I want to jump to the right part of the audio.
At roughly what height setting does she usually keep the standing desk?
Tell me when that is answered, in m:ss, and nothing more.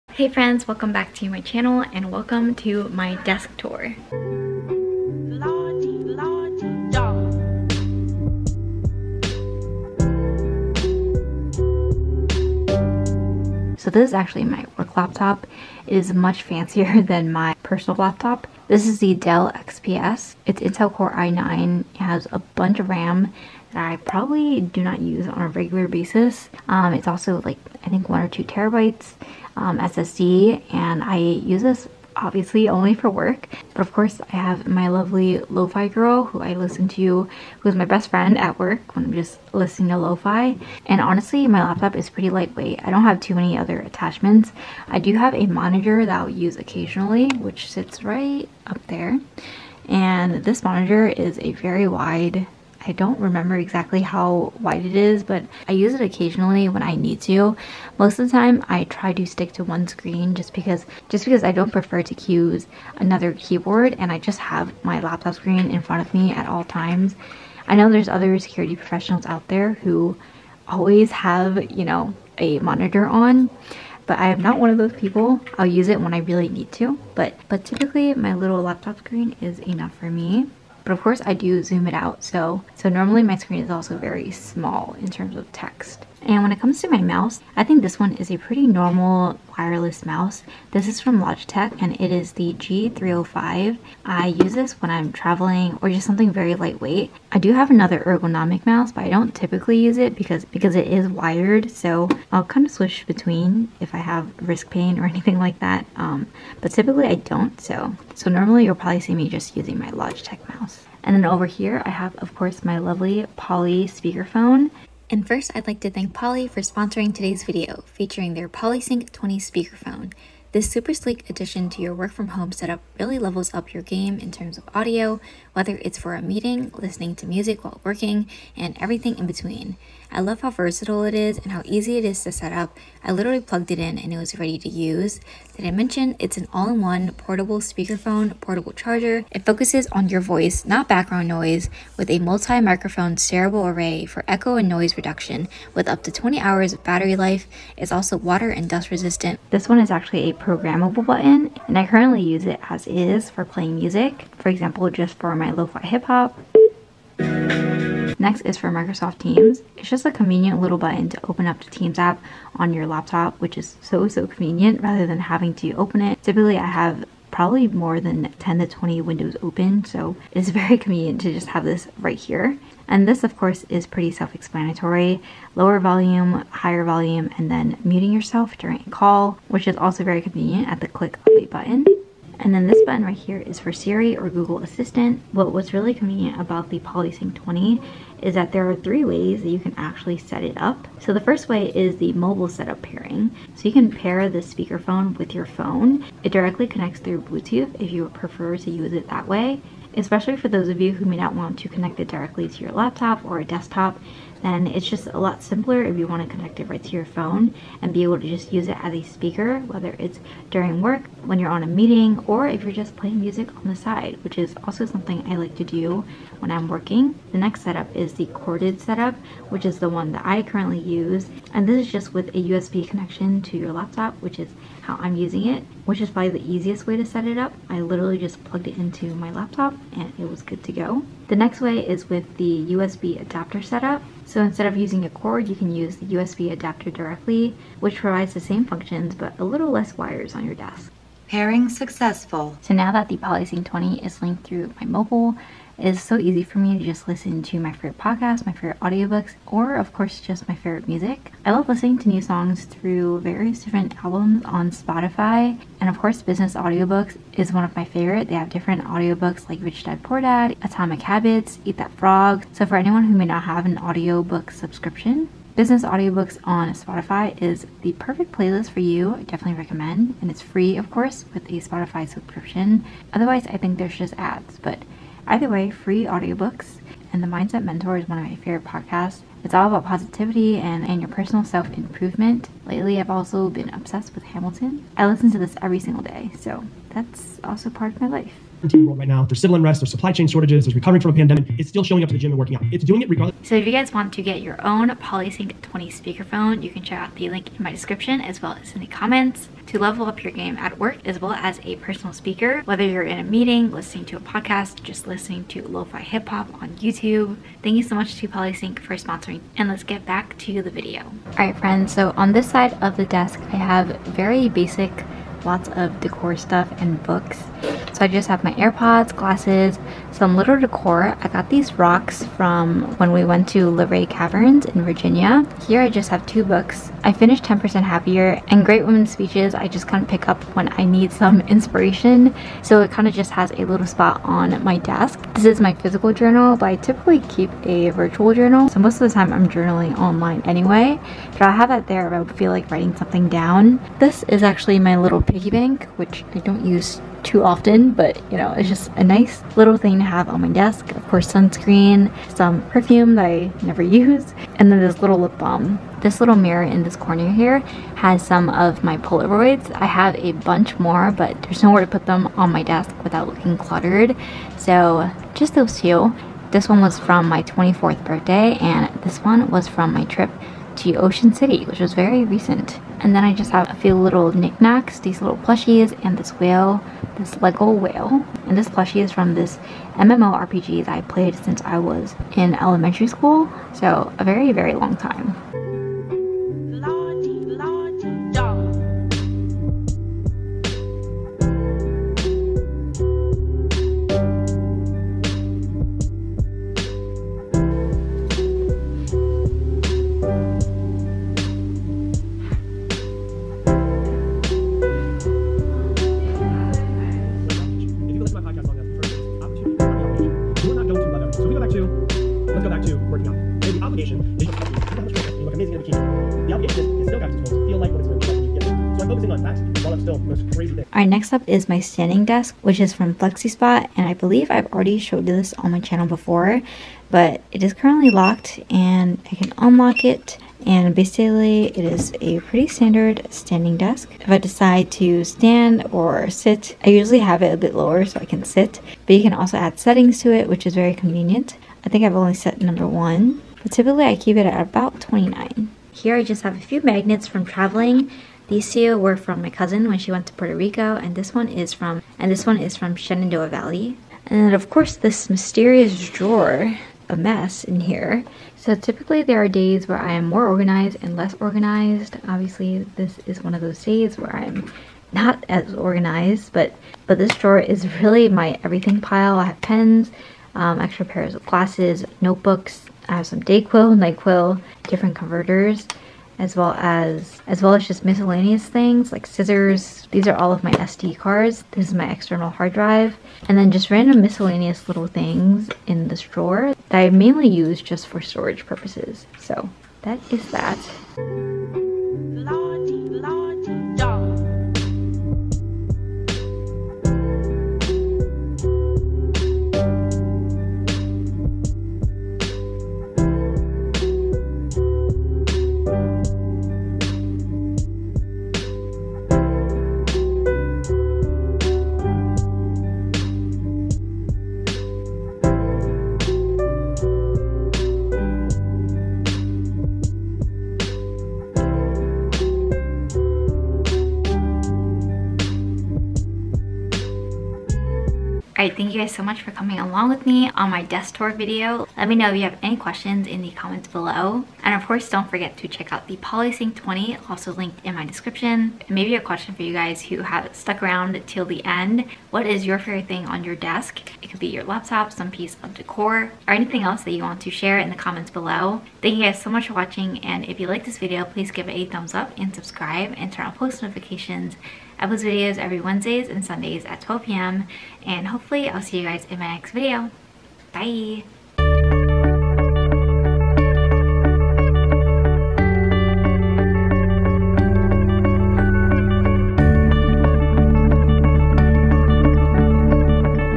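7:25.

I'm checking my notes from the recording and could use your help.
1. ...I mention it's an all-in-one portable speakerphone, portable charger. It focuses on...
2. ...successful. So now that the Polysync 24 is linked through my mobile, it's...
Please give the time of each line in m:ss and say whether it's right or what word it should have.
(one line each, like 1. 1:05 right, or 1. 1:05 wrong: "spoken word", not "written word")
1. 2:15 right
2. 4:01 wrong: "20", not "24".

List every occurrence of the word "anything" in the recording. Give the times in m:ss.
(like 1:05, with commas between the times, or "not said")
1:45, 9:06.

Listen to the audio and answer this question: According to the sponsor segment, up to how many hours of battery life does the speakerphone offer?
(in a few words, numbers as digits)
20 hours.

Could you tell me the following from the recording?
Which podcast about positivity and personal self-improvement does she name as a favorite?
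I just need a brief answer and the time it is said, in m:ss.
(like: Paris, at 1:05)
The Mindset Mentor, at 4:37.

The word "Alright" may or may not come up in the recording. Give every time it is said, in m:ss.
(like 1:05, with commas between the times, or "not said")
7:00, 8:48.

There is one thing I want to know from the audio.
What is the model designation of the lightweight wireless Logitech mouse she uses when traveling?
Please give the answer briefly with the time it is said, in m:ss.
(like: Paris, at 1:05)
G305, at 1:32.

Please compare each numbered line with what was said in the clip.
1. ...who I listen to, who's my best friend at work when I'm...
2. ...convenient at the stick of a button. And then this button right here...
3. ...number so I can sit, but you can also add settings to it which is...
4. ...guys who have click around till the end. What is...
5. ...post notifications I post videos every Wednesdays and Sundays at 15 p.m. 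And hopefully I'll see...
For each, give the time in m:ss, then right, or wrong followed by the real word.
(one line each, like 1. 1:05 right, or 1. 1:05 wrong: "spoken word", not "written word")
1. 0:36 right
2. 3:00 wrong: "click", not "stick"
3. 7:17 wrong: "lower", not "number"
4. 8:59 wrong: "stuck", not "click"
5. 9:13 wrong: "12", not "15".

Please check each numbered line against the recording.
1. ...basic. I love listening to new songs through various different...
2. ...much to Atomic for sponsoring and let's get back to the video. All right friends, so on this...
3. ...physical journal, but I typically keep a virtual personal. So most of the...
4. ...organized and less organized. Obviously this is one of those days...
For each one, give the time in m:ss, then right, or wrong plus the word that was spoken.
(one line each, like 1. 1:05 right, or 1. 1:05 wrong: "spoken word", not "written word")
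1. 4:10 wrong: "music", not "basic"
2. 5:07 wrong: "Polysync", not "Atomic"
3. 5:35 wrong: "journal", not "personal"
4. 7:40 right.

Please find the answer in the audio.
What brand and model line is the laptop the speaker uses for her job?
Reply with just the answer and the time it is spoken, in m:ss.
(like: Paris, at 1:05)
Dell XPS, at 0:19.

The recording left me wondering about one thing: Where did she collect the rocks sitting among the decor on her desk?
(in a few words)
Liberty Caverns.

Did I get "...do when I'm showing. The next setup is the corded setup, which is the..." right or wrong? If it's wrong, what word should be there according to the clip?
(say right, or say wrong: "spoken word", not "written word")
wrong: "working", not "showing".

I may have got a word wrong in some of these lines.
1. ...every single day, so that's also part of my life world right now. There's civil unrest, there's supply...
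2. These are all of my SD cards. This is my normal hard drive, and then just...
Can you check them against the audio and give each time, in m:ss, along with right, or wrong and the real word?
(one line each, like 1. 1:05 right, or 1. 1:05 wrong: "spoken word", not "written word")
1. 4:45 right
2. 8:00 wrong: "external", not "normal".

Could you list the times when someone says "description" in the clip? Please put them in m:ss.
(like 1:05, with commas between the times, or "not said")
4:57, 8:58.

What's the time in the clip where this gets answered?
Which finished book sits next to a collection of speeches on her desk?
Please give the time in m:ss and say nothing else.
5:27.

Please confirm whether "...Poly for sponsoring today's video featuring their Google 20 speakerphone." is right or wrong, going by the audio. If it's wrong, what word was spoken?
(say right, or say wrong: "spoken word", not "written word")
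wrong: "PolySync", not "Google".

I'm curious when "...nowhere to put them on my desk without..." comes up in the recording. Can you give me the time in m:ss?
6:01.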